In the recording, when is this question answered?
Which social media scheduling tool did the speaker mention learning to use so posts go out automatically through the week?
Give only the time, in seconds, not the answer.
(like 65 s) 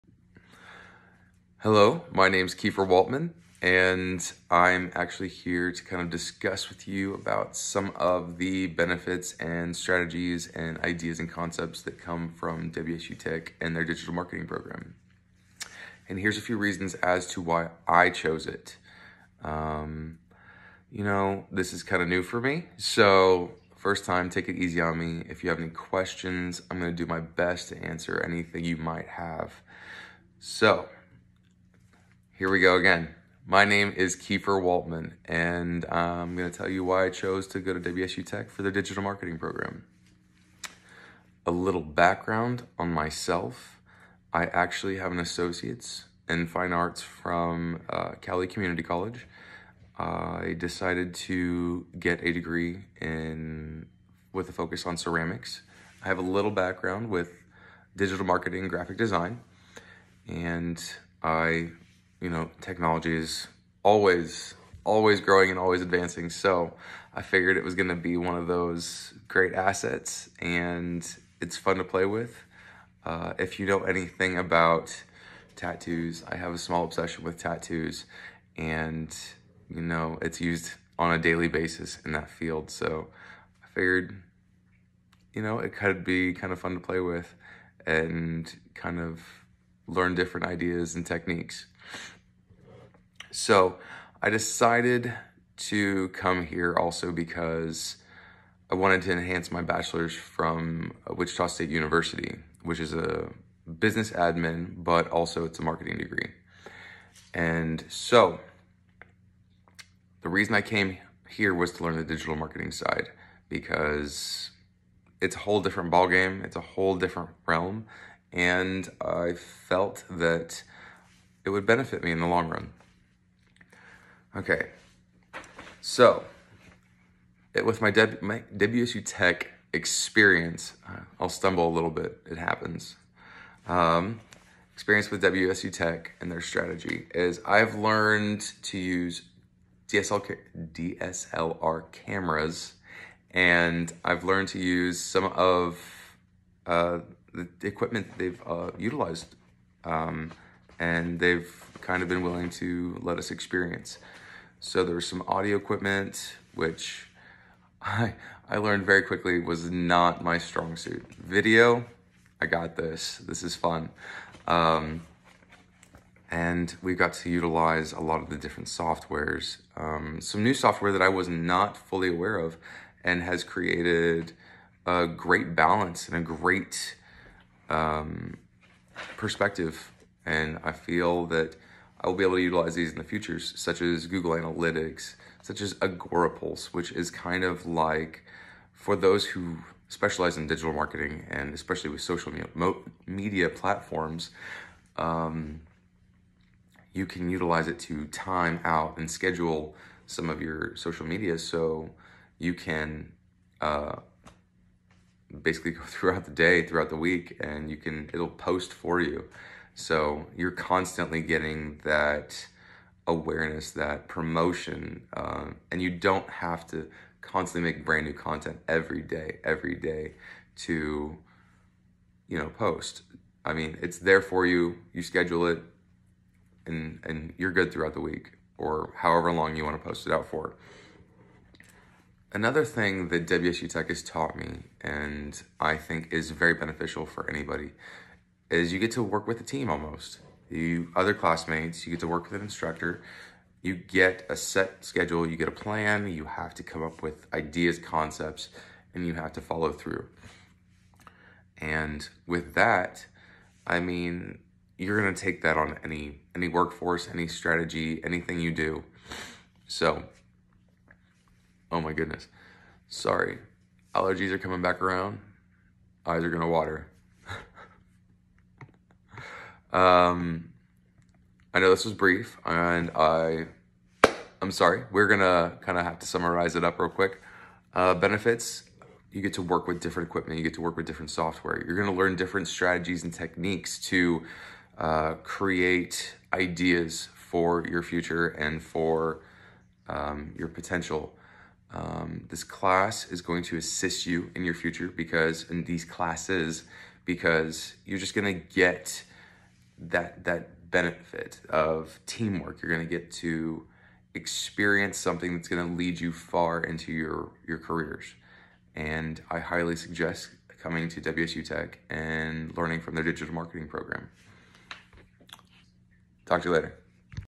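185 s.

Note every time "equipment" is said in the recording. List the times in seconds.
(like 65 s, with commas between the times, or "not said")
147 s, 155 s, 280 s.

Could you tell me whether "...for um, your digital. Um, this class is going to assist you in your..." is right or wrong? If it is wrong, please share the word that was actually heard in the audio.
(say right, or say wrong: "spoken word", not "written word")
wrong: "potential", not "digital".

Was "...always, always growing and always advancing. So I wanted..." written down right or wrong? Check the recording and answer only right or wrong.
wrong.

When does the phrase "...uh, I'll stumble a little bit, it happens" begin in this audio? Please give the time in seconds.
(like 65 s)
130 s.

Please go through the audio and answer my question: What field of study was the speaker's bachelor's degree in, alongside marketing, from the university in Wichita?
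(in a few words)
Business admin.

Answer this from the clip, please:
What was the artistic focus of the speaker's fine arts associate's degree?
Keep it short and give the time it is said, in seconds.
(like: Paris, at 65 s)
Ceramics, at 54 s.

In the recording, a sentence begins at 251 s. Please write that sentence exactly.
And with that, I mean, you're gonna take that on any any workforce, any strategy, anything you do.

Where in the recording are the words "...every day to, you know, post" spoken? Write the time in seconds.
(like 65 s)
219 s.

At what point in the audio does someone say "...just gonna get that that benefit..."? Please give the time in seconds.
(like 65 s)
297 s.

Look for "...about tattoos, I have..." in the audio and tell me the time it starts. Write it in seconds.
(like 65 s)
74 s.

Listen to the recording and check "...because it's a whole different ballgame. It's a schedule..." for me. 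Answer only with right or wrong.
wrong.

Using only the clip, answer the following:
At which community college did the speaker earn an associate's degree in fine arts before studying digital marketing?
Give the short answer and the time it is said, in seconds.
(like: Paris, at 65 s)
Cowley Community College, at 48 s.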